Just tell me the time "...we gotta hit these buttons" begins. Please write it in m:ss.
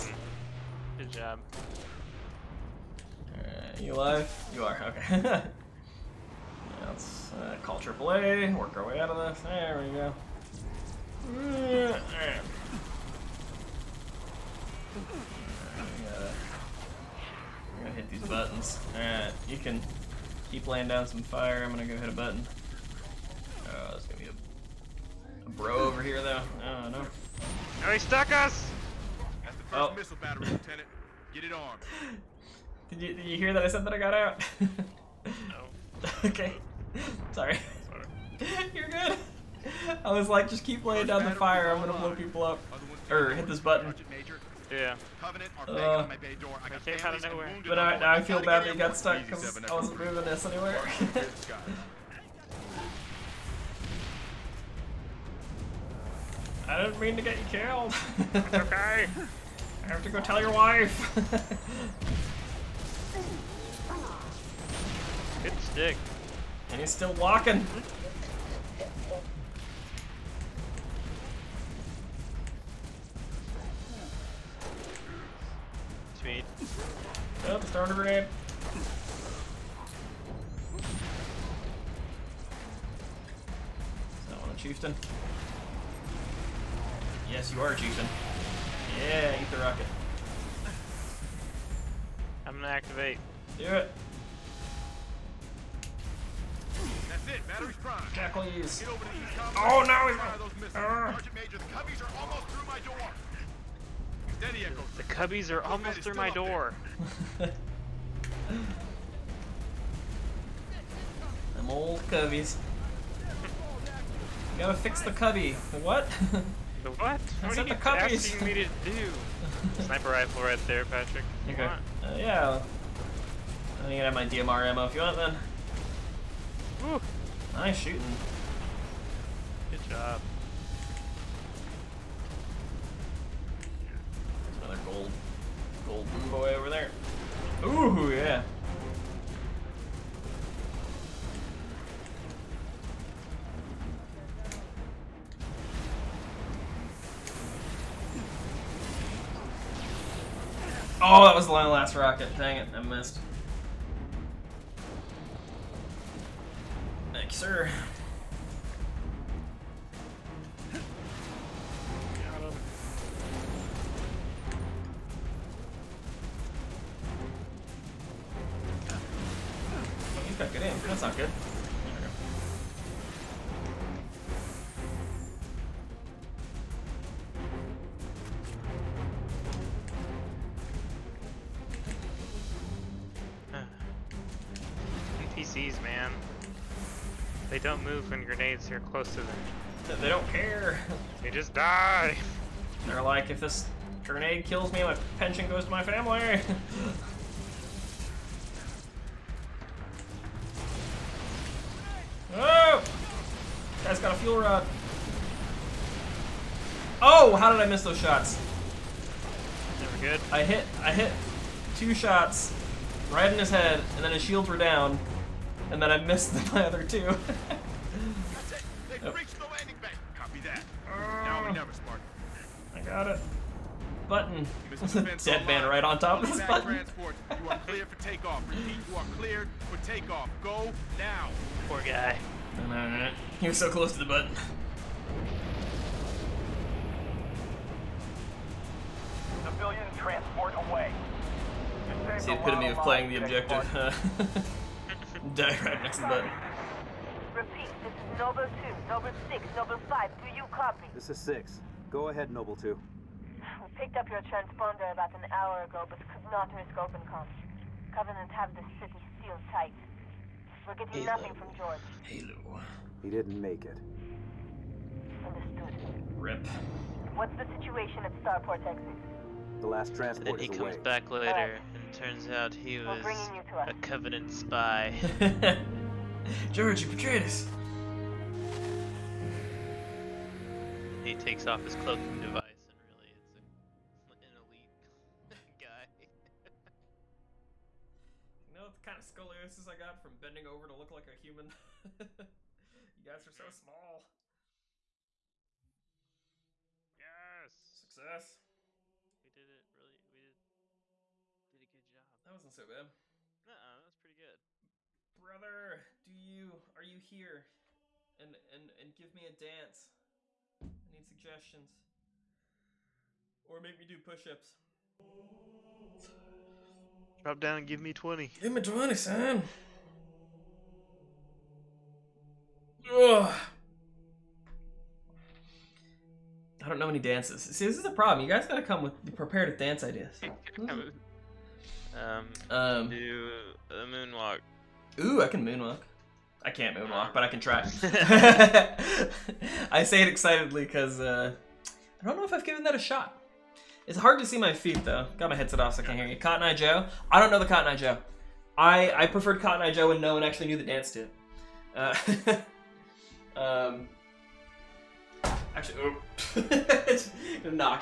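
0:17.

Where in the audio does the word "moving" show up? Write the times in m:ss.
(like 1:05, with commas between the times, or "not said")
0:49.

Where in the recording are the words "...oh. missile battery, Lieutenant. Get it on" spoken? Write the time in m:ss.
0:29.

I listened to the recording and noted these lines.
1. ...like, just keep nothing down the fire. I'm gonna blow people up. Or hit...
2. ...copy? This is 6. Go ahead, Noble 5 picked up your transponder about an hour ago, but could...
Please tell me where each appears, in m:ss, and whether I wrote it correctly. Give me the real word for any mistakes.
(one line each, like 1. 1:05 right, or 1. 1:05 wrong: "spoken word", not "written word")
1. 0:40 wrong: "laying", not "nothing"
2. 4:10 wrong: "2", not "5".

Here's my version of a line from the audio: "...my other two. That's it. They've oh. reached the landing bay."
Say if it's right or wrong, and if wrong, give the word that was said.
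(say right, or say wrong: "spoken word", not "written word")
right.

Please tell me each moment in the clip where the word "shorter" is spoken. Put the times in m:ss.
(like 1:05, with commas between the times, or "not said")
not said.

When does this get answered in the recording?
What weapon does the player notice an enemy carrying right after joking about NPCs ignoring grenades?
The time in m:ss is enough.
3:24.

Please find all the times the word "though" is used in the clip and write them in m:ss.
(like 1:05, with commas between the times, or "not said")
0:26, 5:44.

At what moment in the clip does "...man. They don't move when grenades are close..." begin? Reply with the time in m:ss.
3:05.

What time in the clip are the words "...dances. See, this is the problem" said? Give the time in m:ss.
5:27.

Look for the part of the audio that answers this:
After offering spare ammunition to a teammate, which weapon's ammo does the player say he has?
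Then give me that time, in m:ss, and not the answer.
2:04.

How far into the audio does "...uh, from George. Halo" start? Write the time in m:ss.
4:21.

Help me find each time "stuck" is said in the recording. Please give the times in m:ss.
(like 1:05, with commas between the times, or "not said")
0:27, 0:48.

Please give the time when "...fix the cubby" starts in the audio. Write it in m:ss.
1:54.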